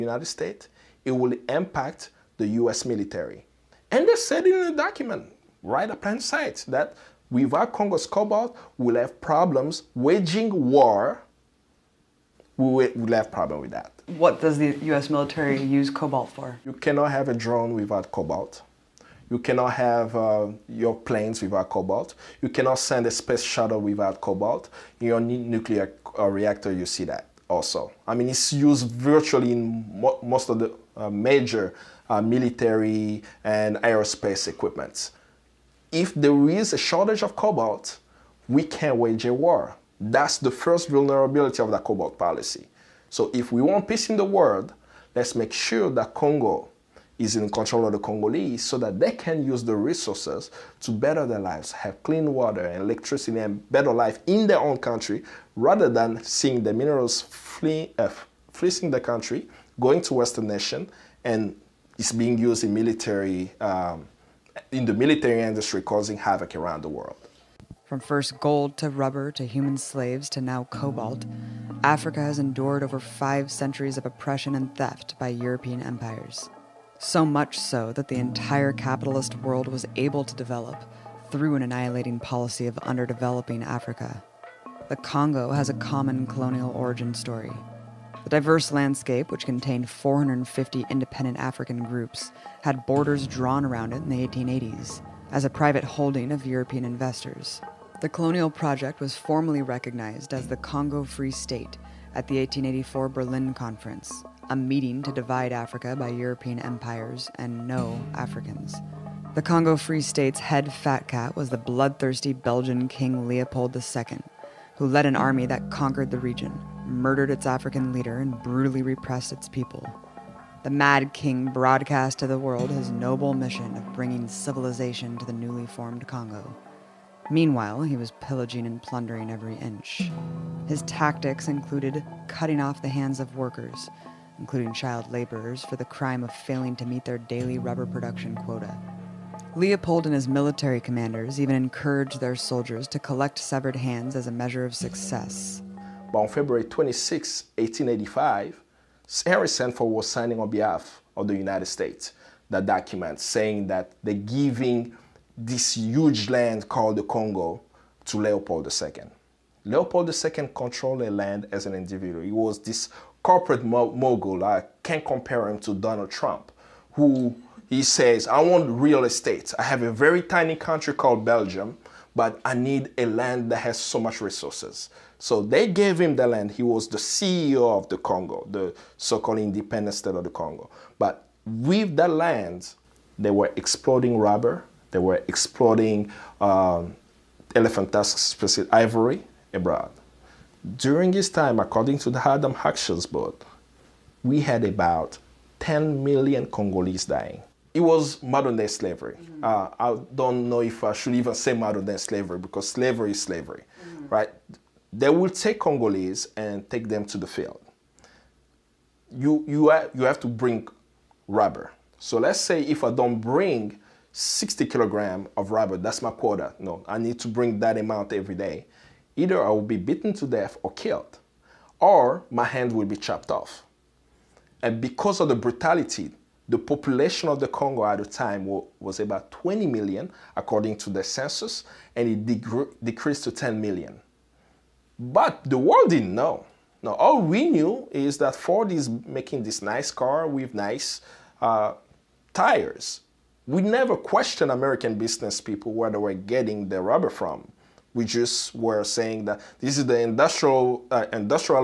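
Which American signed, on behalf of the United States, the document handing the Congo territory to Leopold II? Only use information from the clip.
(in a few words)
Henry Sanford.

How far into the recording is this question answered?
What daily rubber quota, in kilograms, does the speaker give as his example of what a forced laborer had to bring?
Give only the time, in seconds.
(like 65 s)
214 s.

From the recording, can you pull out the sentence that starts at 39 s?
That's the first vulnerability of the cobalt policy.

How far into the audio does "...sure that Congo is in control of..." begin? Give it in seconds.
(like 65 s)
45 s.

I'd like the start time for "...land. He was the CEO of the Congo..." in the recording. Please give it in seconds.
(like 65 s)
176 s.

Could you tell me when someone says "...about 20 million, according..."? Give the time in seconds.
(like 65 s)
228 s.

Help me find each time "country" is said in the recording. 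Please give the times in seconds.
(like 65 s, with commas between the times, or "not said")
54 s, 58 s, 170 s.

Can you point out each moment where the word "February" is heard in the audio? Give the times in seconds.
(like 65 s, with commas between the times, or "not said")
146 s.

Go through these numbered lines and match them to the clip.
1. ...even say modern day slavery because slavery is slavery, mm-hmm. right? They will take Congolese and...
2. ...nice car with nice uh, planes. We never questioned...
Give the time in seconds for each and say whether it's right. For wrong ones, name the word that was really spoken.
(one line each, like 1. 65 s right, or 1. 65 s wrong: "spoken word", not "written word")
1. 201 s right
2. 239 s wrong: "tires", not "planes".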